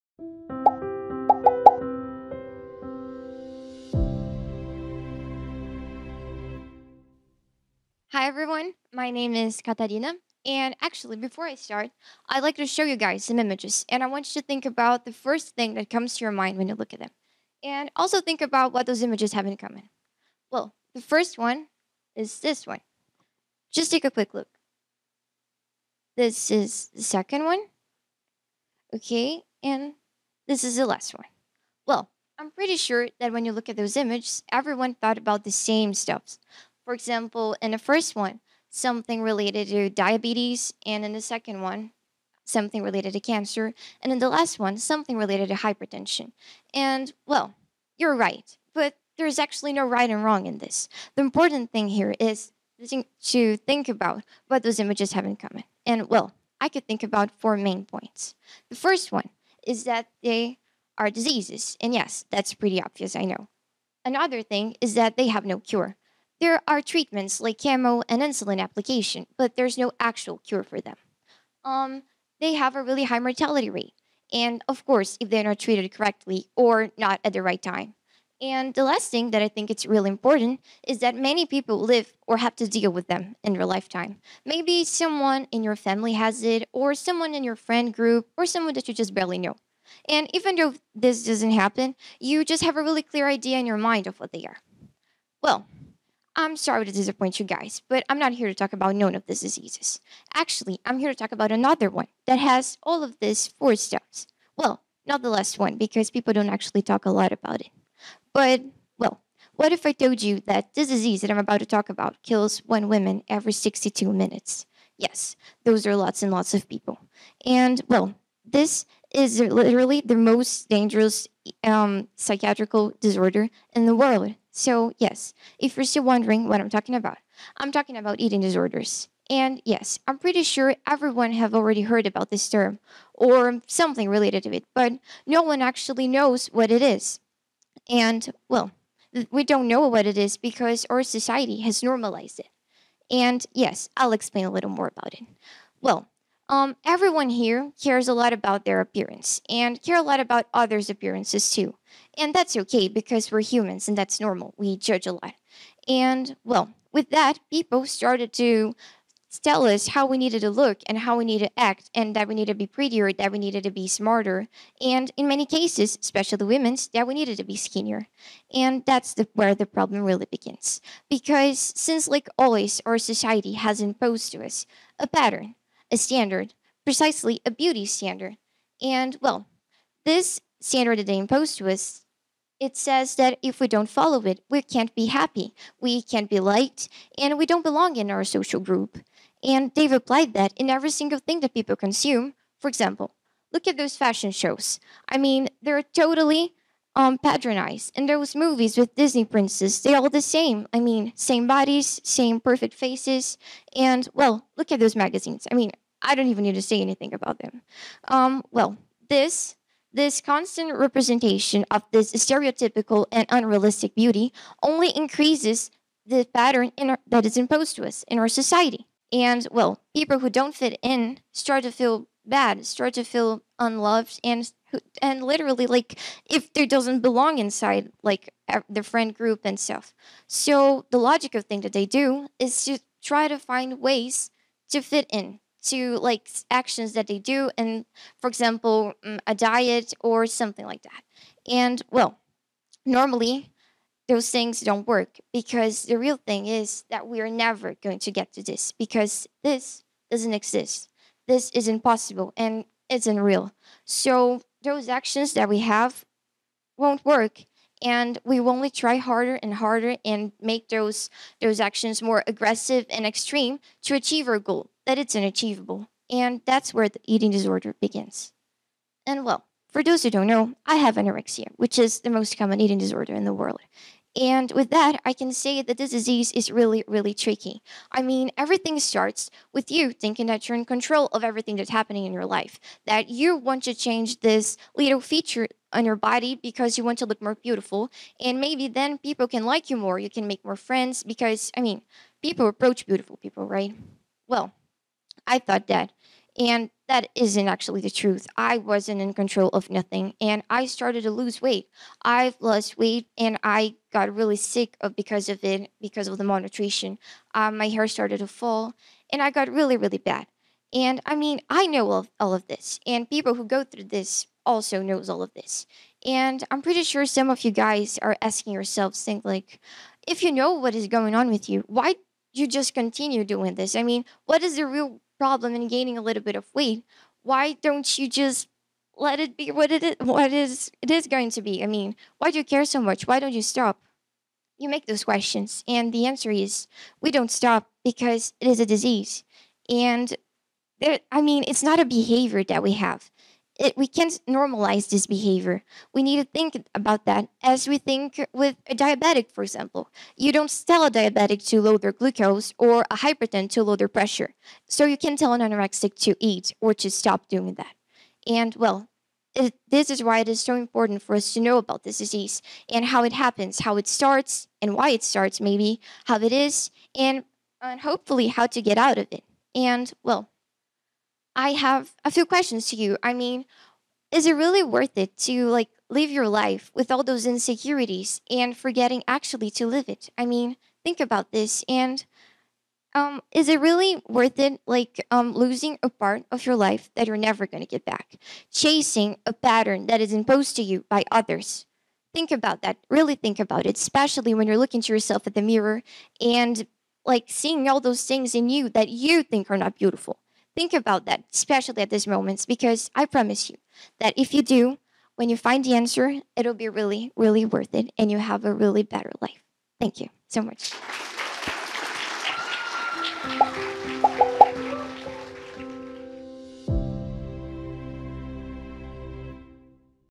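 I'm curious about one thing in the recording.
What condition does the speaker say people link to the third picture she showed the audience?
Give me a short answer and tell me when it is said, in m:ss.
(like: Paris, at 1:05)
hypertension, at 0:45.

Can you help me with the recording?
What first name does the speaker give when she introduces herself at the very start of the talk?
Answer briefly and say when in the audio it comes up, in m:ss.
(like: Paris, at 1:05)
Catarina, at 0:09.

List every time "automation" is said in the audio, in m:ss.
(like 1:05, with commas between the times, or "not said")
not said.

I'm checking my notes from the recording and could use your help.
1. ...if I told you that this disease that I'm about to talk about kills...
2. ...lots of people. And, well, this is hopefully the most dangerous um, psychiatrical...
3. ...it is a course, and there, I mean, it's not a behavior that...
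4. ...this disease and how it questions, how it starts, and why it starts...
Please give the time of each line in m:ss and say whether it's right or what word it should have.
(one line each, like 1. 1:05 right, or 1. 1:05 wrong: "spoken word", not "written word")
1. 1:49 right
2. 1:56 wrong: "literally", not "hopefully"
3. 5:38 wrong: "disease", not "course"
4. 6:01 wrong: "happens", not "questions".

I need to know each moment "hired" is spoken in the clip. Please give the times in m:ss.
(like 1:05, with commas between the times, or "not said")
not said.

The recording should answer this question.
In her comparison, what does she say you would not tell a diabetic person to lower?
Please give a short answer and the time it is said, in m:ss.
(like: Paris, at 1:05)
glucose, at 5:51.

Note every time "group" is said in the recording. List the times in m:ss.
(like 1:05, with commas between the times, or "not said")
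1:27, 3:08, 3:49.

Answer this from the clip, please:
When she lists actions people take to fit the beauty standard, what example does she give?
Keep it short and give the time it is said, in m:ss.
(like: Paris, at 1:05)
a diet, at 3:59.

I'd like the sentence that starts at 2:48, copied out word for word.
And that's the, where the problem really begins.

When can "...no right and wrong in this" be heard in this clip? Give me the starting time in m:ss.
0:49.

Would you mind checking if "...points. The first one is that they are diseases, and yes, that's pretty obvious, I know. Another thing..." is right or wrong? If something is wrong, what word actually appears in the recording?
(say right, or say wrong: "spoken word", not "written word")
right.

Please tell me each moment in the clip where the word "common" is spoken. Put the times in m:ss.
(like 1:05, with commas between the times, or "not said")
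0:19, 0:55, 4:32.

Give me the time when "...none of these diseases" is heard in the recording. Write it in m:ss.
1:38.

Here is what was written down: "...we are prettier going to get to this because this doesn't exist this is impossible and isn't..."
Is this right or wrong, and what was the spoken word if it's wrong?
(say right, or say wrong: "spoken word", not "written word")
wrong: "never", not "prettier".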